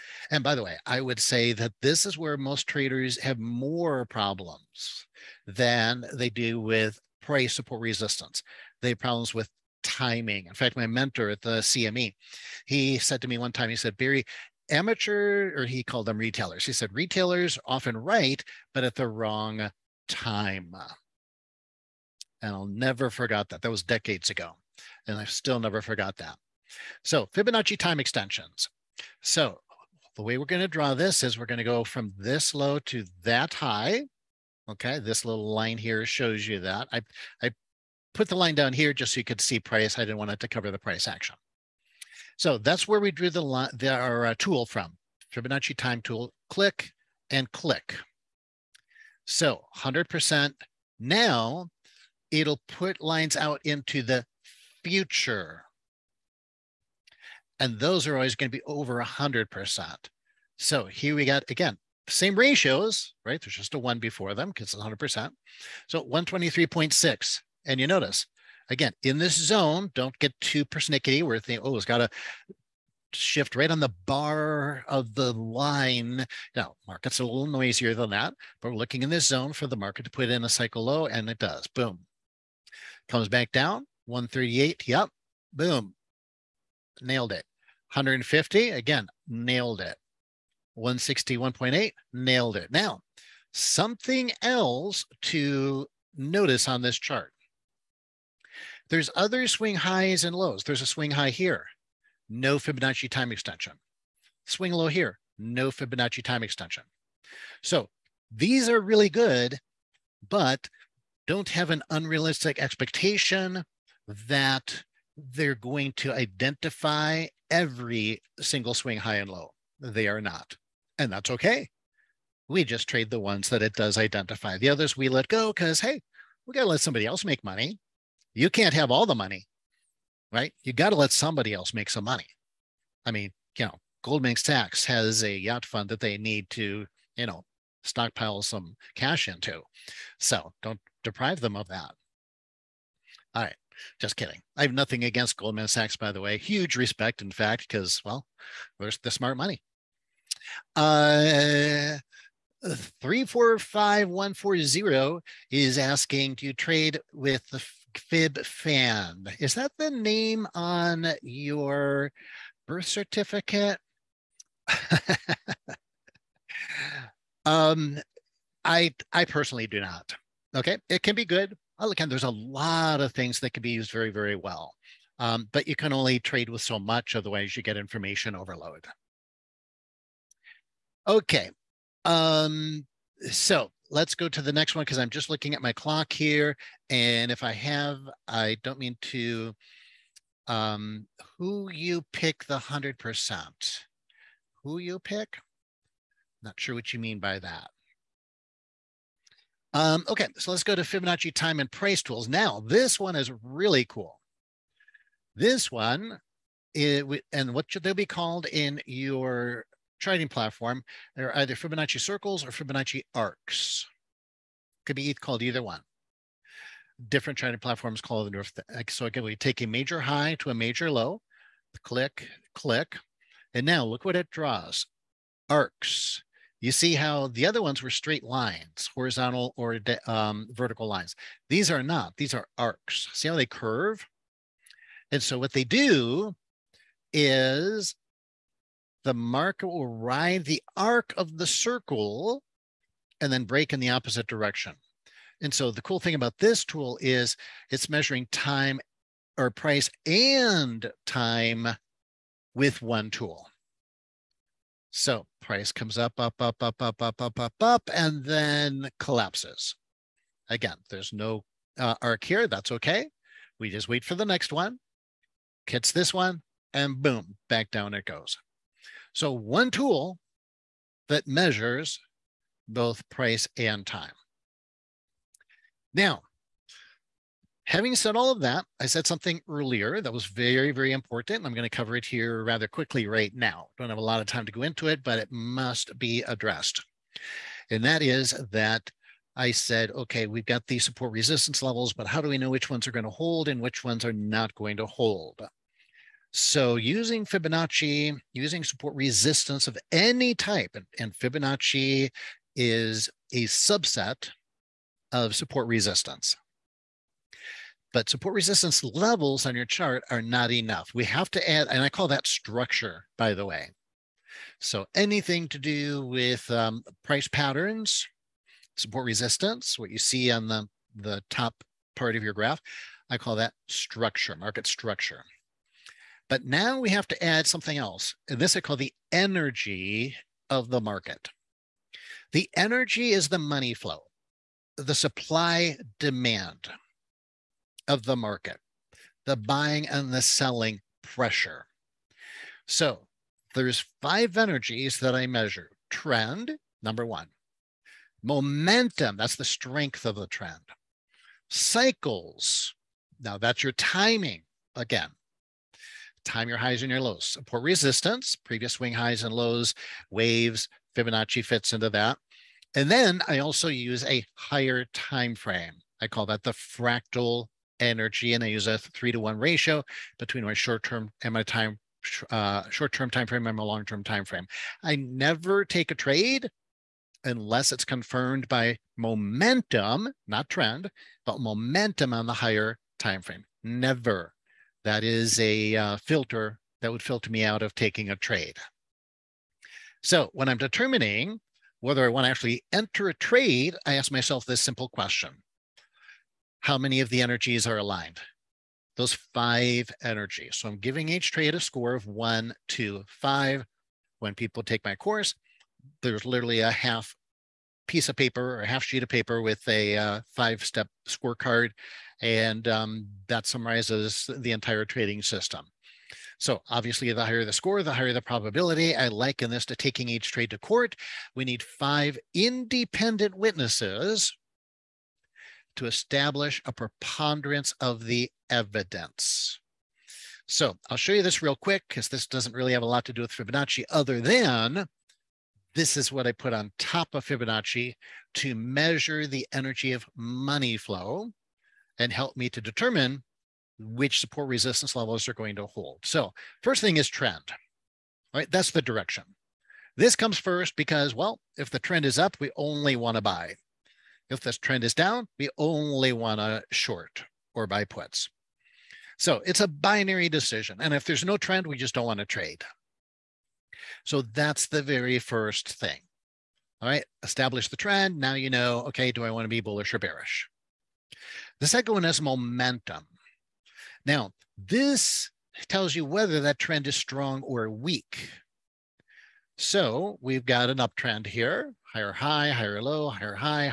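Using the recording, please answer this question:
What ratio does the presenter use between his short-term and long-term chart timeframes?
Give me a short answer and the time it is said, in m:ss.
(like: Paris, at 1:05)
3 to 1, at 6:08.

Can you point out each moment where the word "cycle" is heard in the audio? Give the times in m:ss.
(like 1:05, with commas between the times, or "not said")
1:20, 5:51.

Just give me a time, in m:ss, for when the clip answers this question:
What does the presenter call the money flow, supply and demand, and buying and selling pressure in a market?
5:29.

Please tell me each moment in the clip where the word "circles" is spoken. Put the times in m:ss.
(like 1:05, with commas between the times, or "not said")
3:32, 4:01.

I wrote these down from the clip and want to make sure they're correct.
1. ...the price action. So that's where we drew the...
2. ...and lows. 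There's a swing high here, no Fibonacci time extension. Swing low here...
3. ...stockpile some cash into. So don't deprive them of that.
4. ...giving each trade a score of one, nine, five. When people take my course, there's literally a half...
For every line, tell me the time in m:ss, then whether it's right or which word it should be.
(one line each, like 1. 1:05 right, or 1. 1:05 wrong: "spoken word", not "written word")
1. 0:40 right
2. 1:40 right
3. 2:17 right
4. 6:40 wrong: "two", not "nine".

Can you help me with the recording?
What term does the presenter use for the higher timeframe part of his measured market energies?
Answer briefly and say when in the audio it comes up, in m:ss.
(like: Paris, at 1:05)
fractal energy, at 6:06.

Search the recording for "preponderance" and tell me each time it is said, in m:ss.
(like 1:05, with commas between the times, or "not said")
7:06.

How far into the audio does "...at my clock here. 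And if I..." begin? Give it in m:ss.
3:05.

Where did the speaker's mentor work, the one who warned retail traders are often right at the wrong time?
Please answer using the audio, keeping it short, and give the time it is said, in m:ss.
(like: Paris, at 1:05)
CME, at 0:11.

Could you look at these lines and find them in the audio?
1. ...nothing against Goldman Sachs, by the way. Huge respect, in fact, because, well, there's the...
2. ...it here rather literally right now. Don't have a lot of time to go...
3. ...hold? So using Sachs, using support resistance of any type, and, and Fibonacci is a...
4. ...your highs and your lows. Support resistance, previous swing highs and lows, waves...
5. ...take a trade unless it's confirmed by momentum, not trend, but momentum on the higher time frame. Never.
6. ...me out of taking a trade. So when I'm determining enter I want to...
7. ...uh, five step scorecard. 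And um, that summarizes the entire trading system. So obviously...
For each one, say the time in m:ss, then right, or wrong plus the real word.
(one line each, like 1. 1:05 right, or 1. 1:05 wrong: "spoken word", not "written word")
1. 2:24 right
2. 4:41 wrong: "quickly", not "literally"
3. 4:54 wrong: "Fibonacci", not "Sachs"
4. 5:56 right
5. 6:15 right
6. 6:27 wrong: "whether", not "enter"
7. 6:49 right.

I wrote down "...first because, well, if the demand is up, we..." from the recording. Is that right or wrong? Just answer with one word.
wrong.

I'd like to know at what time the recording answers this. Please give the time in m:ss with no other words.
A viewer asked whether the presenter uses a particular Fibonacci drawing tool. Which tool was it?
2:37.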